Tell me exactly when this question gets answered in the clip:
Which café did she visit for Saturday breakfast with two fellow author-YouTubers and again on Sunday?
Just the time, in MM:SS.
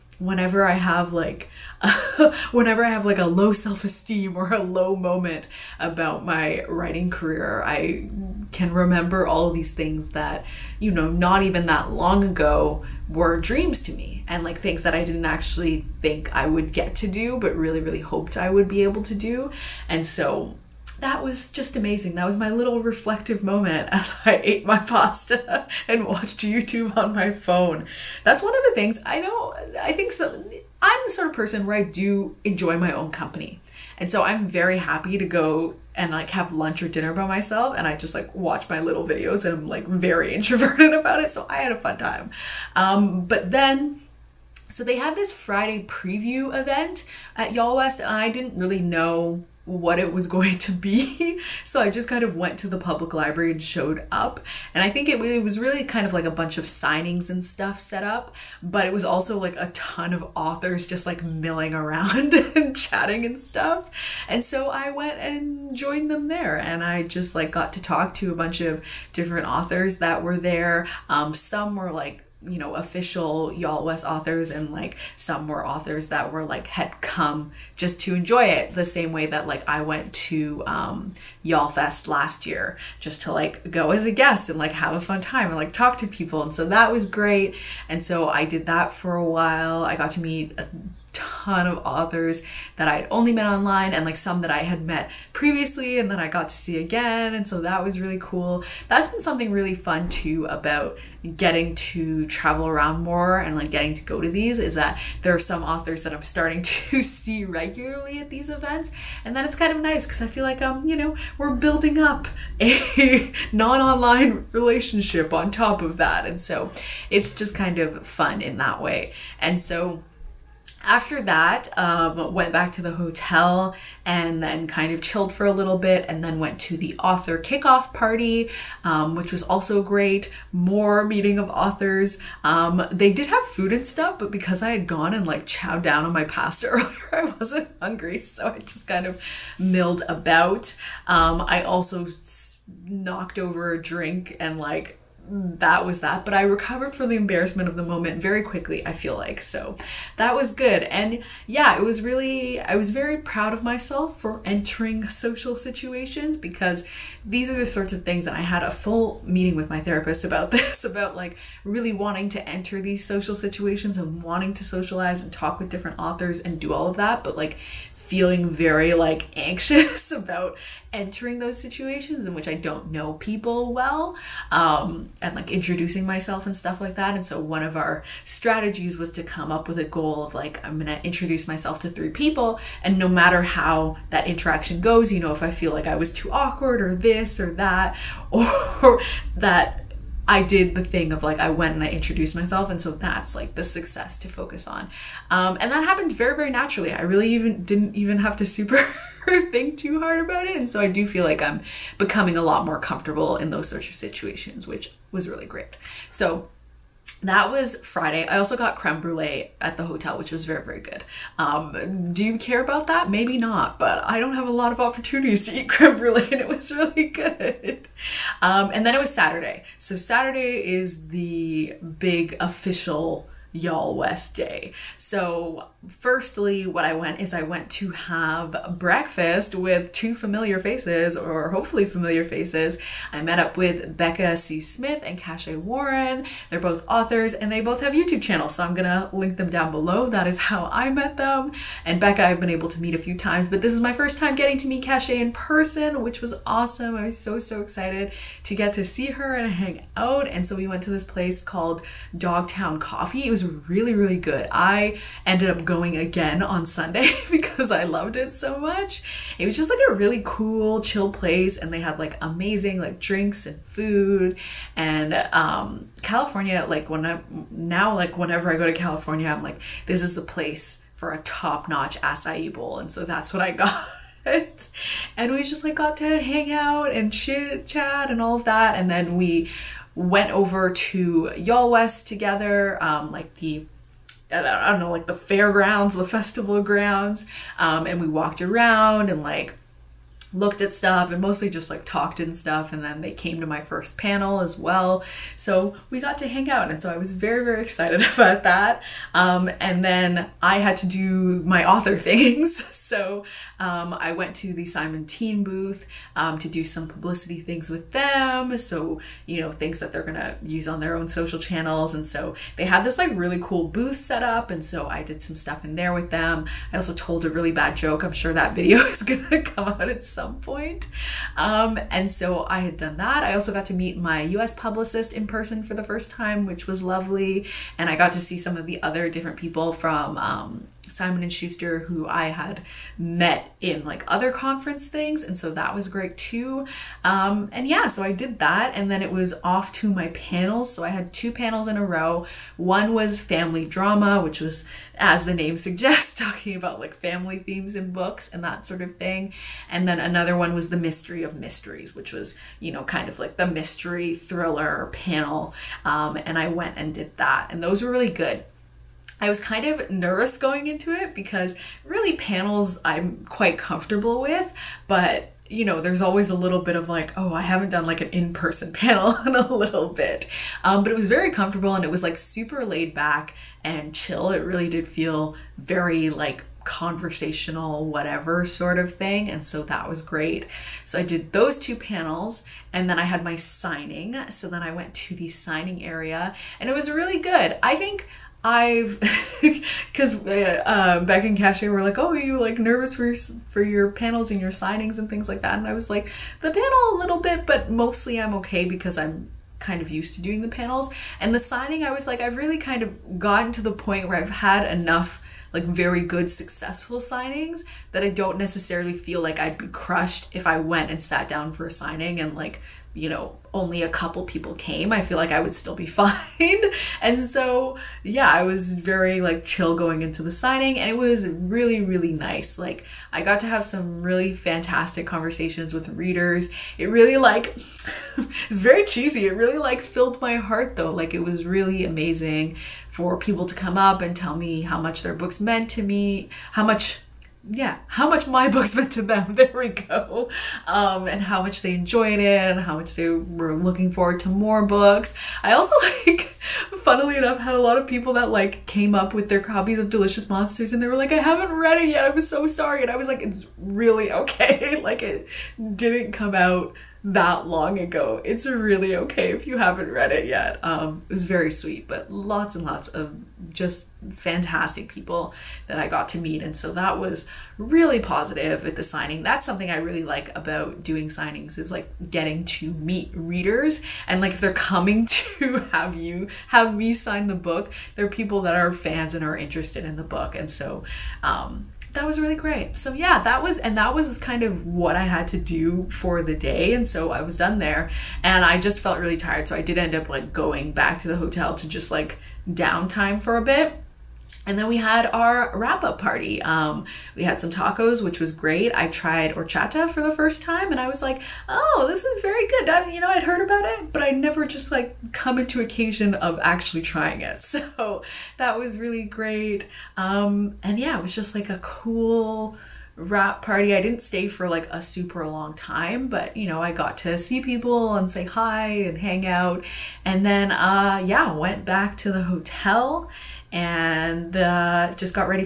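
04:12.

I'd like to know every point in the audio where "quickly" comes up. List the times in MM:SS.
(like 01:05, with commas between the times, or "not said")
02:28.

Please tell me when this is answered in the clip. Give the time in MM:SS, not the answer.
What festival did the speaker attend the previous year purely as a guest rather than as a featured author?
01:21.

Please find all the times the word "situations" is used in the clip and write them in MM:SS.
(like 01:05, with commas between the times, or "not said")
02:35, 02:43, 02:51, 03:23.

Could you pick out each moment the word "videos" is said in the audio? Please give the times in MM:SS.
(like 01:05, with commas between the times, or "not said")
00:39, 05:18.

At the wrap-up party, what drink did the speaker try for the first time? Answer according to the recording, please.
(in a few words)
horchata.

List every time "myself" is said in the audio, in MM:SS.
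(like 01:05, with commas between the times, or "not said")
00:37, 02:33, 02:56, 03:01, 03:12.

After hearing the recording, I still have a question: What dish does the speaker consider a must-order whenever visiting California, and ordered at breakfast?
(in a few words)
acai bowl.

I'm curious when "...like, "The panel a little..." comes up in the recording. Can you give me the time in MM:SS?
06:35.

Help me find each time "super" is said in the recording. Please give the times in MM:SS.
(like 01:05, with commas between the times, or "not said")
03:18, 06:12, 08:34.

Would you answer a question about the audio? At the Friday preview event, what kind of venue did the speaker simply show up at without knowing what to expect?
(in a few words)
public library.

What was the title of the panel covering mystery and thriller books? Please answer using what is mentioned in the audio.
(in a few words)
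The Mystery of Mysteries.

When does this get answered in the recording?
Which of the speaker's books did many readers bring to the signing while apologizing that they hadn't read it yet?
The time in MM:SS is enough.
07:29.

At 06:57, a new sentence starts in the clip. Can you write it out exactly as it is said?
and so, yeah, I was very like chill going into the signing and it was really, really nice.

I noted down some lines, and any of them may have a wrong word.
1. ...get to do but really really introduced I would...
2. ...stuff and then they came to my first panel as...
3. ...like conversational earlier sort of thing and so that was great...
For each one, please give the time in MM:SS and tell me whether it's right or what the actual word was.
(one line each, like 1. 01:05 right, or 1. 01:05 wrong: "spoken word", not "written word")
1. 00:16 wrong: "hoped", not "introduced"
2. 04:52 right
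3. 06:16 wrong: "whatever", not "earlier".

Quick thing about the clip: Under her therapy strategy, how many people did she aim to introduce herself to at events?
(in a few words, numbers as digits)
3.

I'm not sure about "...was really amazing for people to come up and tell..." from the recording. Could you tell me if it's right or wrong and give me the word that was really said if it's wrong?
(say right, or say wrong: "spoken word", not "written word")
right.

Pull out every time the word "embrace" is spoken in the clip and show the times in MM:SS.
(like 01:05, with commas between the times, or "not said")
not said.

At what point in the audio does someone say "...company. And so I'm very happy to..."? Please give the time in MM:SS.
00:33.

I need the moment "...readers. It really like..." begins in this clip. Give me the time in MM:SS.
07:05.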